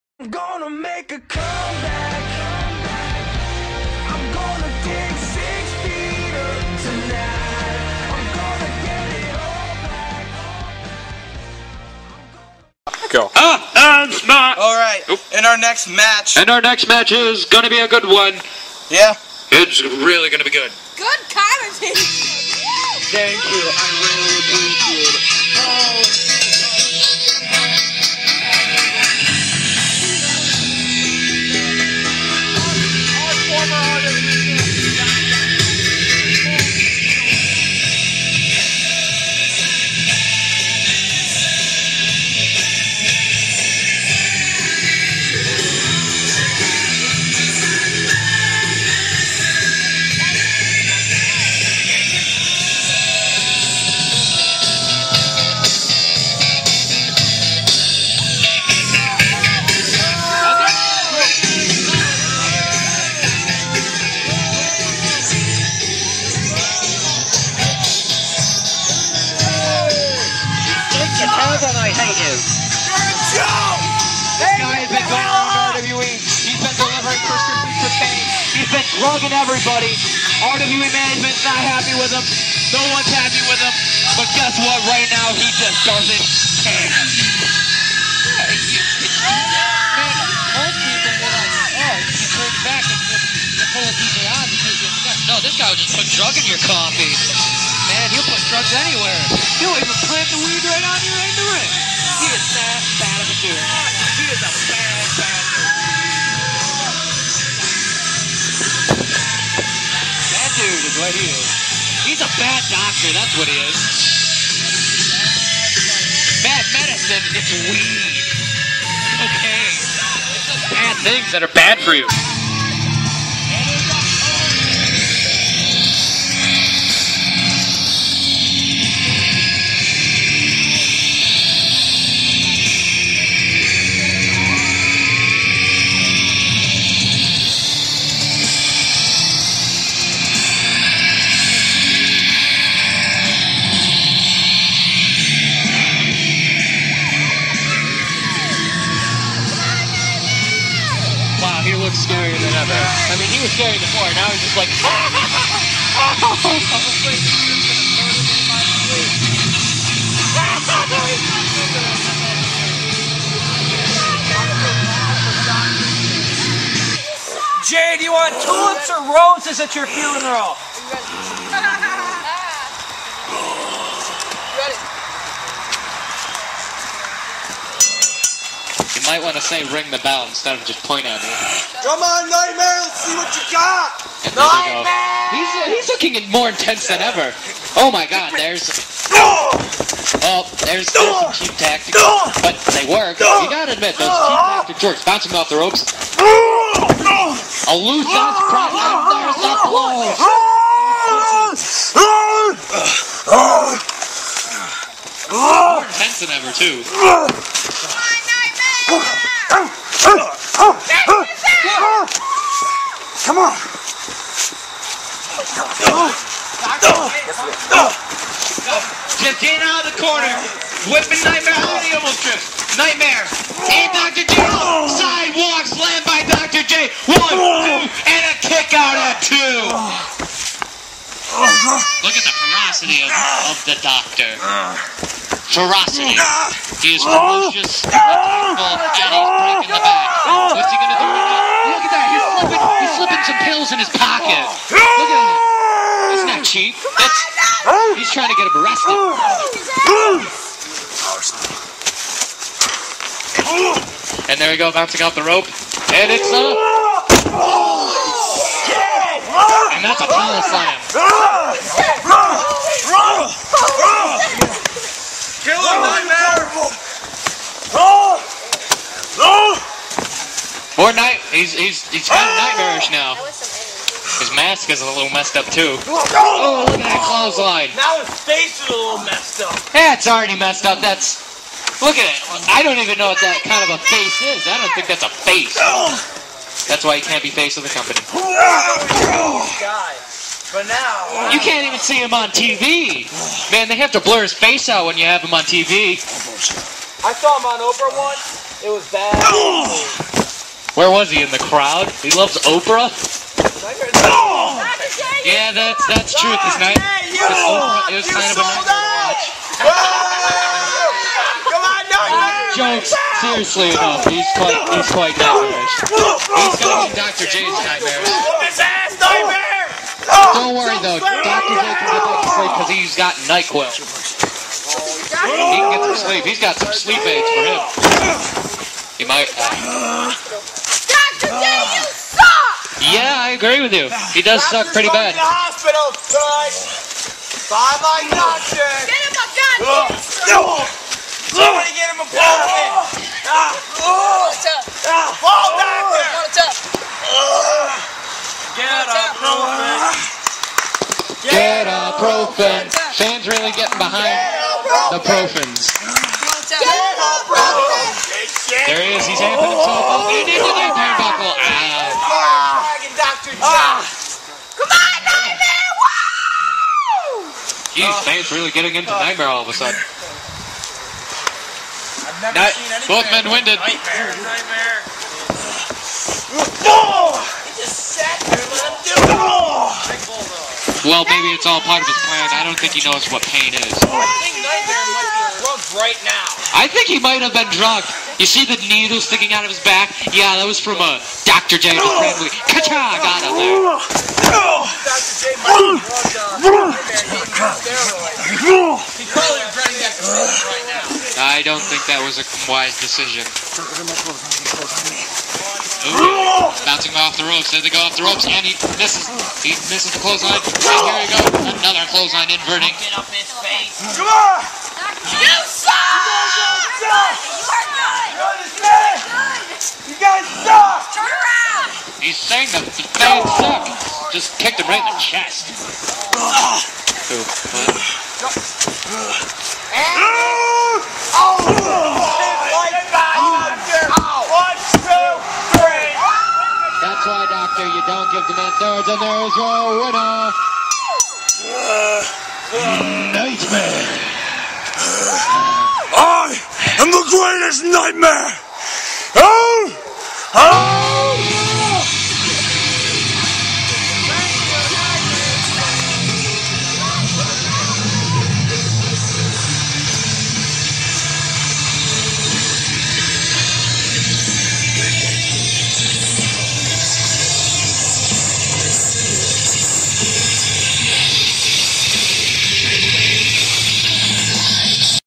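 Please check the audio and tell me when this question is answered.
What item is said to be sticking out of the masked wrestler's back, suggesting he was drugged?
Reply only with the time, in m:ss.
6:28.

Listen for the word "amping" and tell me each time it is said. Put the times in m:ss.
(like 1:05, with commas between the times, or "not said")
5:59.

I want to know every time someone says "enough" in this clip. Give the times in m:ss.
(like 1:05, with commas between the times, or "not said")
5:13.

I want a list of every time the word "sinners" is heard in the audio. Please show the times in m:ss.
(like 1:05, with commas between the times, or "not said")
not said.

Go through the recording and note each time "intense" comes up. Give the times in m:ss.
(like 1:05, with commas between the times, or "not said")
3:06, 3:25.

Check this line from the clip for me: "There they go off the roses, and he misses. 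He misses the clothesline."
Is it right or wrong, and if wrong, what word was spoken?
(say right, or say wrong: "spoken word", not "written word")
wrong: "ropes", not "roses".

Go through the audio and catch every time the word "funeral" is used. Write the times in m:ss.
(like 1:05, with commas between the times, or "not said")
2:49.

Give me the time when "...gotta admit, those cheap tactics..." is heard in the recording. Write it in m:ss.
3:13.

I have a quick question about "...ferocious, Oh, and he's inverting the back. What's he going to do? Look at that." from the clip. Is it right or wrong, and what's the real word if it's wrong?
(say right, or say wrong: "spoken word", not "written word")
wrong: "breaking", not "inverting".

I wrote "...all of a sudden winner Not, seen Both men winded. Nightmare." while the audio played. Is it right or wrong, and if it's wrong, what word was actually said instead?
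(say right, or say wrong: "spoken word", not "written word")
wrong: "never", not "winner".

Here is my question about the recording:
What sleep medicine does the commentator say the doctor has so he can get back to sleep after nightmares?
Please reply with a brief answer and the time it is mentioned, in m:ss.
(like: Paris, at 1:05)
NyQuil, at 5:23.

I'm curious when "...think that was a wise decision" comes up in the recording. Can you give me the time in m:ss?
6:41.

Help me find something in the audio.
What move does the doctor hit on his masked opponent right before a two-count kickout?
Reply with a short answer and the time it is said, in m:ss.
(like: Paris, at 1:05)
Sidewalk slam, at 3:44.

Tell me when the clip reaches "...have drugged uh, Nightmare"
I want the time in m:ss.
6:35.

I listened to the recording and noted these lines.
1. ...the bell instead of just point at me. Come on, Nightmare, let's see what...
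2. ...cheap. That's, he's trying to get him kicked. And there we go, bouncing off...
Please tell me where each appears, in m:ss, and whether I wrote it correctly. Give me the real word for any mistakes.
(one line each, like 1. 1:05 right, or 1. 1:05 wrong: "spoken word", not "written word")
1. 2:59 right
2. 4:06 wrong: "arrested", not "kicked".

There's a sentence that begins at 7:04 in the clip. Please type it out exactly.
Just kicked him right in the chest.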